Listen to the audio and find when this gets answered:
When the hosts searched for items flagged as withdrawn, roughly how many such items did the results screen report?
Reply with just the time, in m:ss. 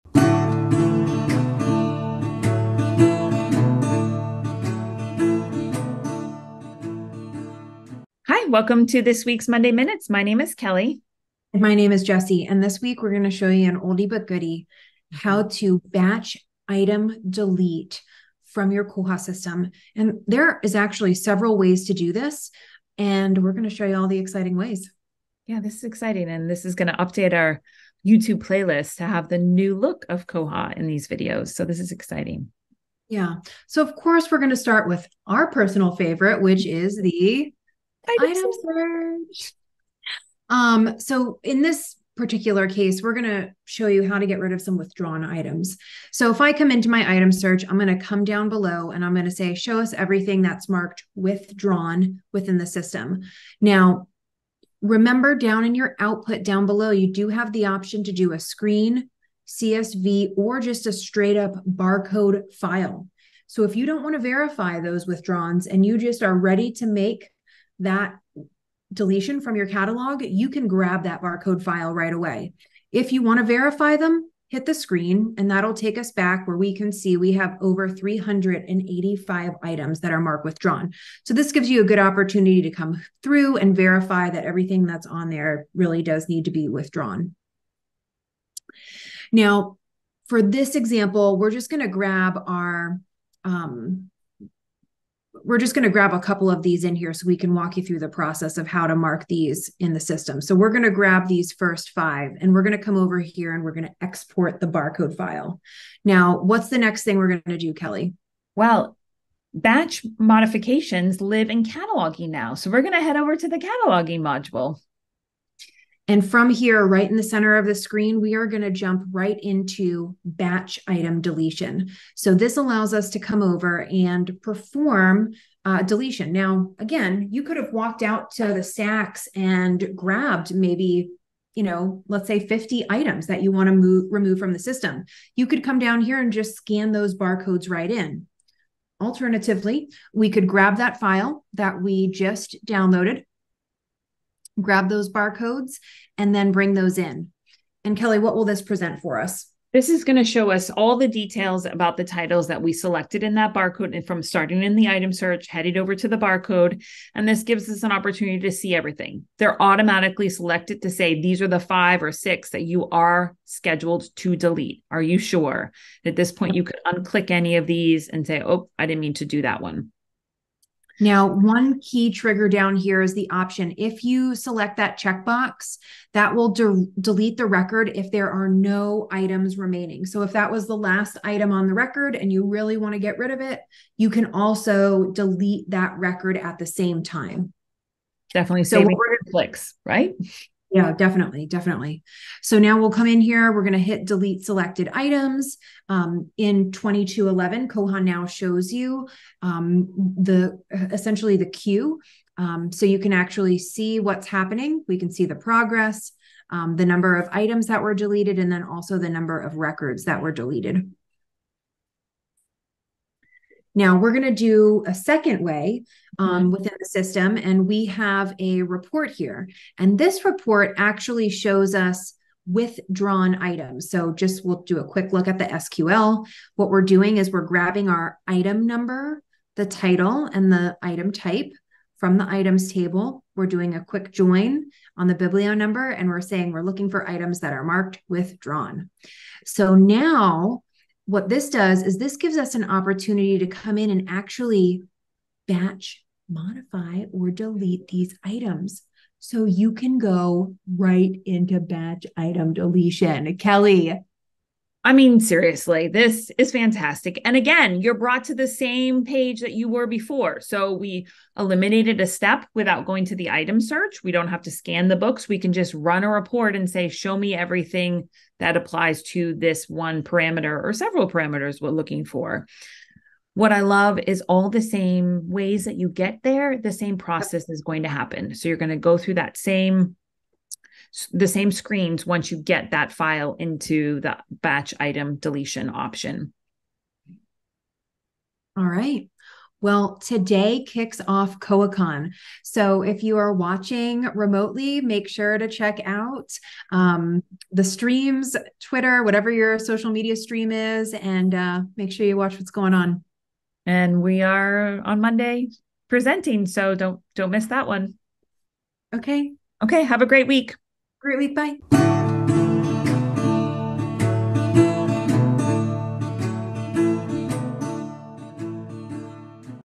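1:17.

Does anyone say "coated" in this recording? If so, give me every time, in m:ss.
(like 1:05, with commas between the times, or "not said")
not said.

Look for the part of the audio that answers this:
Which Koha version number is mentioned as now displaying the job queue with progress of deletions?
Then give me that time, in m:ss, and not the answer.
3:16.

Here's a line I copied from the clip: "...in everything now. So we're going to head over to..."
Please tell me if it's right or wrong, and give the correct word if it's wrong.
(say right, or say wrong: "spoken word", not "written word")
wrong: "cataloging", not "everything".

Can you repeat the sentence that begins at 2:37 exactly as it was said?
And this gives us an opportunity to see everything.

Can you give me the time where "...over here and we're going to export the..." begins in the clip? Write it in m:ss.
1:42.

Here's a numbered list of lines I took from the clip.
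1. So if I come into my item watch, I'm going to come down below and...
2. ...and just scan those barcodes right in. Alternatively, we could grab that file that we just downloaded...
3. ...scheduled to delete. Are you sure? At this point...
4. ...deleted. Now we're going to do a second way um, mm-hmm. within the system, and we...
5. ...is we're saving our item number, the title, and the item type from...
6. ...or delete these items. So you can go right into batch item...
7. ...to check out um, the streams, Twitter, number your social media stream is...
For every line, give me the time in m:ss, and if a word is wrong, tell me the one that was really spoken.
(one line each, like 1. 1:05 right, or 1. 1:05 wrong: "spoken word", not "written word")
1. 0:46 wrong: "search", not "watch"
2. 2:16 right
3. 2:43 right
4. 3:30 right
5. 3:47 wrong: "grabbing", not "saving"
6. 4:07 right
7. 4:55 wrong: "whatever", not "number".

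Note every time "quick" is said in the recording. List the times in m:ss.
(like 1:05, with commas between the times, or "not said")
3:44, 3:53.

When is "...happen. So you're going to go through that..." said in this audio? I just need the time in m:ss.
4:37.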